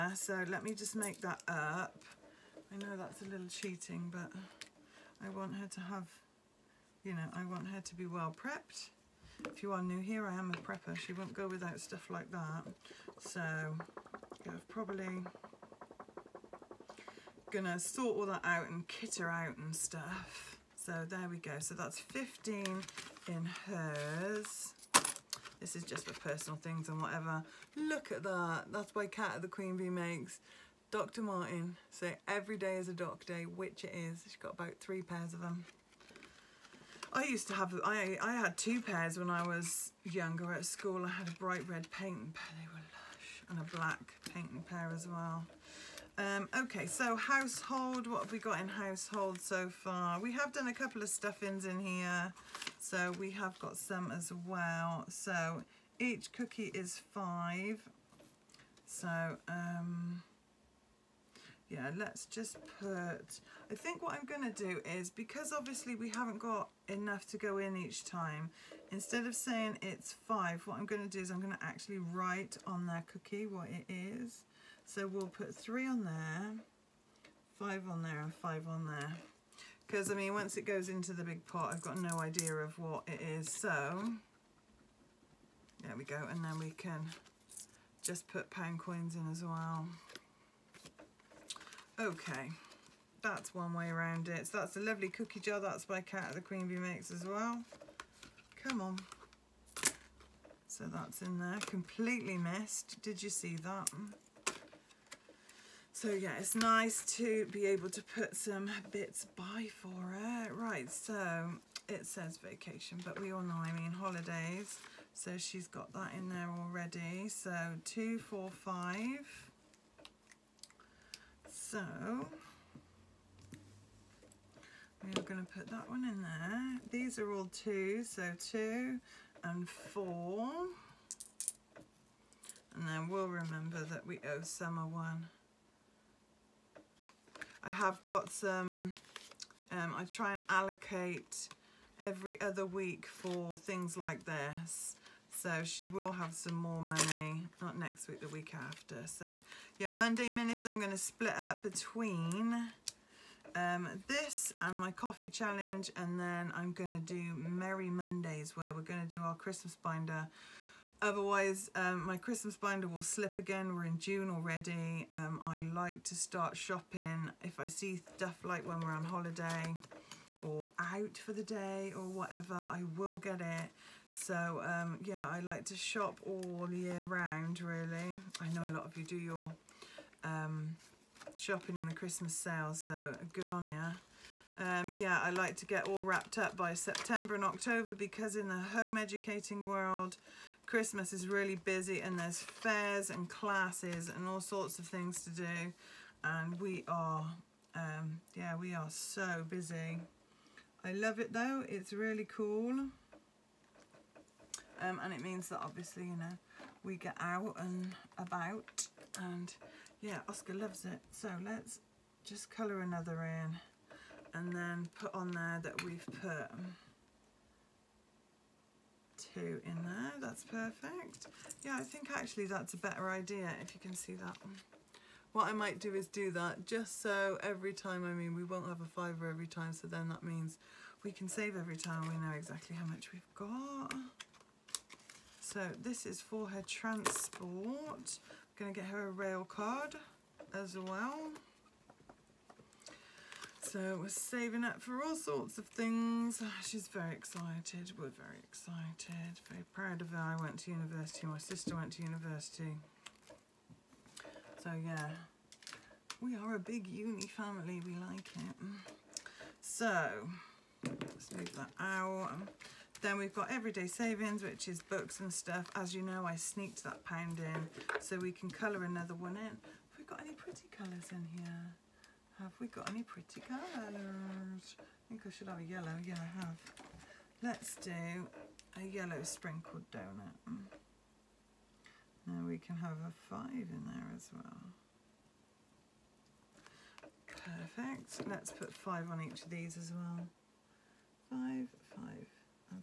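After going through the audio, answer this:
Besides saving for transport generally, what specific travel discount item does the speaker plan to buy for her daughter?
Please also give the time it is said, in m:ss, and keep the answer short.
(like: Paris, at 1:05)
A rail card, at 3:59.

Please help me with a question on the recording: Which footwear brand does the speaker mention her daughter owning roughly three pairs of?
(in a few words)
Dr. Martens.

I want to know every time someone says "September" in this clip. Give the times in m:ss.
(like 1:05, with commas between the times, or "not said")
3:06.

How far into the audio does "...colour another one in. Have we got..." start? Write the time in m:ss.
4:28.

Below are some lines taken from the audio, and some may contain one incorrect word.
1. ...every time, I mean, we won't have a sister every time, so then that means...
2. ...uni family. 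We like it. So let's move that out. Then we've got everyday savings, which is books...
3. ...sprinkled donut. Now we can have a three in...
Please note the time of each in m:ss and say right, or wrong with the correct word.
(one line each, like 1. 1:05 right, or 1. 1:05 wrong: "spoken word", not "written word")
1. 3:47 wrong: "fiver", not "sister"
2. 4:16 right
3. 4:39 wrong: "five", not "three".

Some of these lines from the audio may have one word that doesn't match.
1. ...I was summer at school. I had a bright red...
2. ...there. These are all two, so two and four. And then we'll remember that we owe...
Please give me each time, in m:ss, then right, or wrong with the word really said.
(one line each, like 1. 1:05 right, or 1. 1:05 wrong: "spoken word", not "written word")
1. 0:39 wrong: "younger", not "summer"
2. 2:06 right.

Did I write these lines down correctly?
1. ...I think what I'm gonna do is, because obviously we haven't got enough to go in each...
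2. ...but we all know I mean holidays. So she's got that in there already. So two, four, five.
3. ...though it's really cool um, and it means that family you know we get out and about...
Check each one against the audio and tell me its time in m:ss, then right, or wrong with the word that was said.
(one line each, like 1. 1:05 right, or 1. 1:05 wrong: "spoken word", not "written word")
1. 1:03 right
2. 1:53 right
3. 3:21 wrong: "obviously", not "family".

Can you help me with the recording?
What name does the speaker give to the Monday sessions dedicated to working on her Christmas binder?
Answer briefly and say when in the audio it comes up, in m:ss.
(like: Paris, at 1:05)
Merry Mondays, at 2:37.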